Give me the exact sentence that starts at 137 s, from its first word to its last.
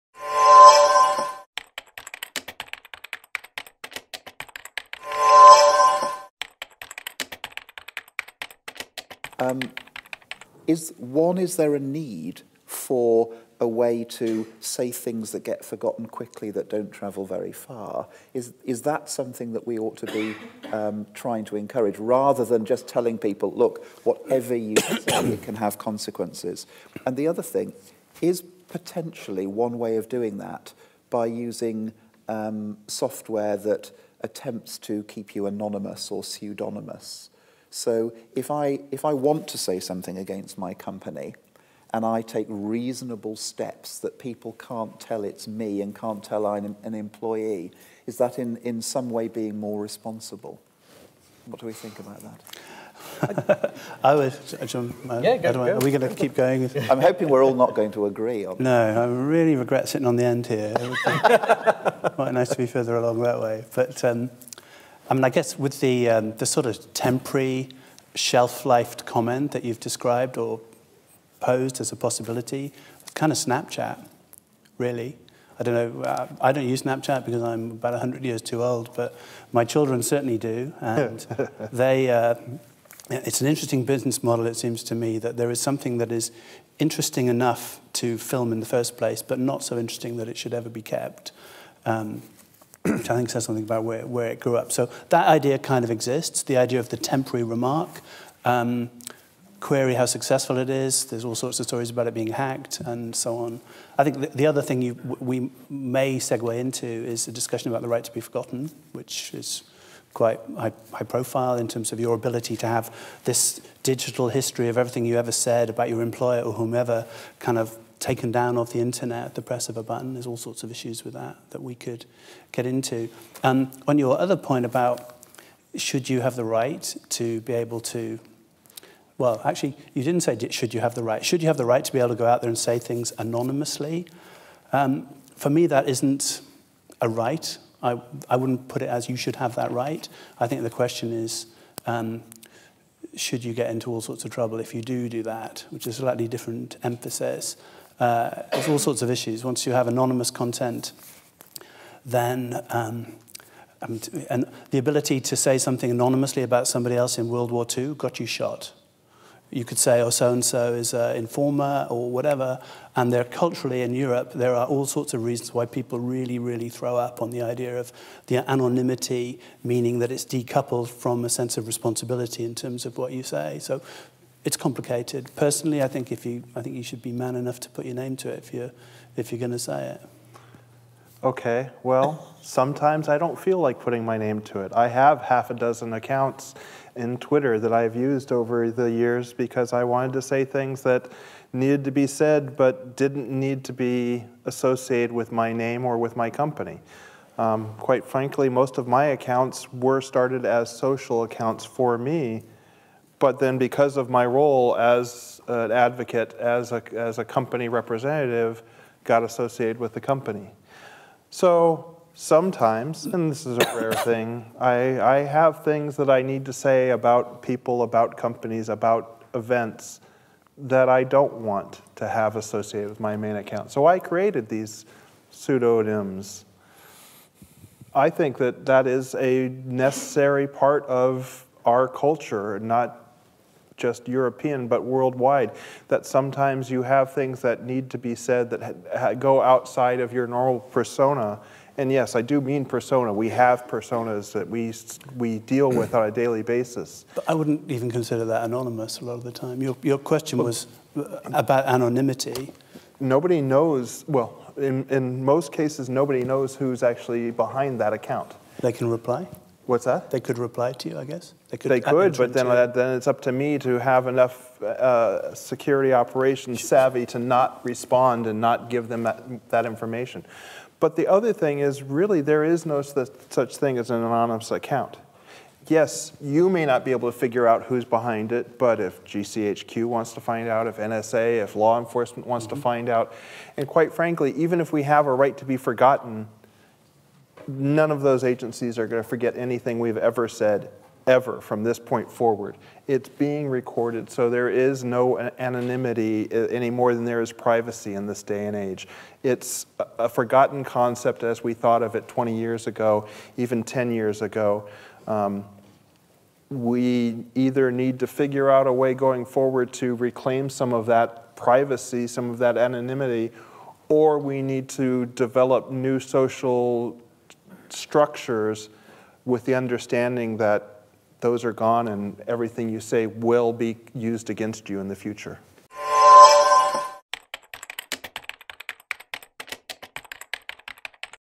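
I, I wouldn't put it as you should have that right.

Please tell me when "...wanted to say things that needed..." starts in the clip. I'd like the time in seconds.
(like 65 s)
189 s.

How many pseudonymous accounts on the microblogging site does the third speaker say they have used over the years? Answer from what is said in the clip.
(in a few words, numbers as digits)
half a dozen.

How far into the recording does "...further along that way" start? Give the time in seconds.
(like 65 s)
62 s.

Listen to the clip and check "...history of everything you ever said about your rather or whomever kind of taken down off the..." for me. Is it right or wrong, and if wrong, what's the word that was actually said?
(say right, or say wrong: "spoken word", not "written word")
wrong: "employer", not "rather".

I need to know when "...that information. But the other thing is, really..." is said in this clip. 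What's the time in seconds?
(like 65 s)
269 s.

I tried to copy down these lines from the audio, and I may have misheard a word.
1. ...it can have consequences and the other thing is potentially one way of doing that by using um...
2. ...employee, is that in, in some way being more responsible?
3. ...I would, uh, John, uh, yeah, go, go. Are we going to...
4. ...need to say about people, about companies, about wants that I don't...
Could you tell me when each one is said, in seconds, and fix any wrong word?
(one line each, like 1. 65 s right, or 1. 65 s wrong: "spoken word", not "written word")
1. 25 s right
2. 46 s right
3. 54 s right
4. 216 s wrong: "events", not "wants".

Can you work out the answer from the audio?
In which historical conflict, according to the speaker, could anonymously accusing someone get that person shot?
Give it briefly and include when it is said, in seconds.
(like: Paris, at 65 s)
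World War II, at 157 s.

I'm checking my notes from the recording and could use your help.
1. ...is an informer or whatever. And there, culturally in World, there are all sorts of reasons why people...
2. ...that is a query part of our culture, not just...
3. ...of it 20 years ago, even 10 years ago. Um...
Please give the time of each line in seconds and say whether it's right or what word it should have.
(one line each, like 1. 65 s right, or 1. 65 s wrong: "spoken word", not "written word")
1. 160 s wrong: "Europe", not "World"
2. 228 s wrong: "necessary", not "query"
3. 301 s right.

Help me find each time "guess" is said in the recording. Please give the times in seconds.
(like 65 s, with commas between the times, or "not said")
65 s, 261 s.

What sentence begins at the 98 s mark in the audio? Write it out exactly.
Um, query how successful it is.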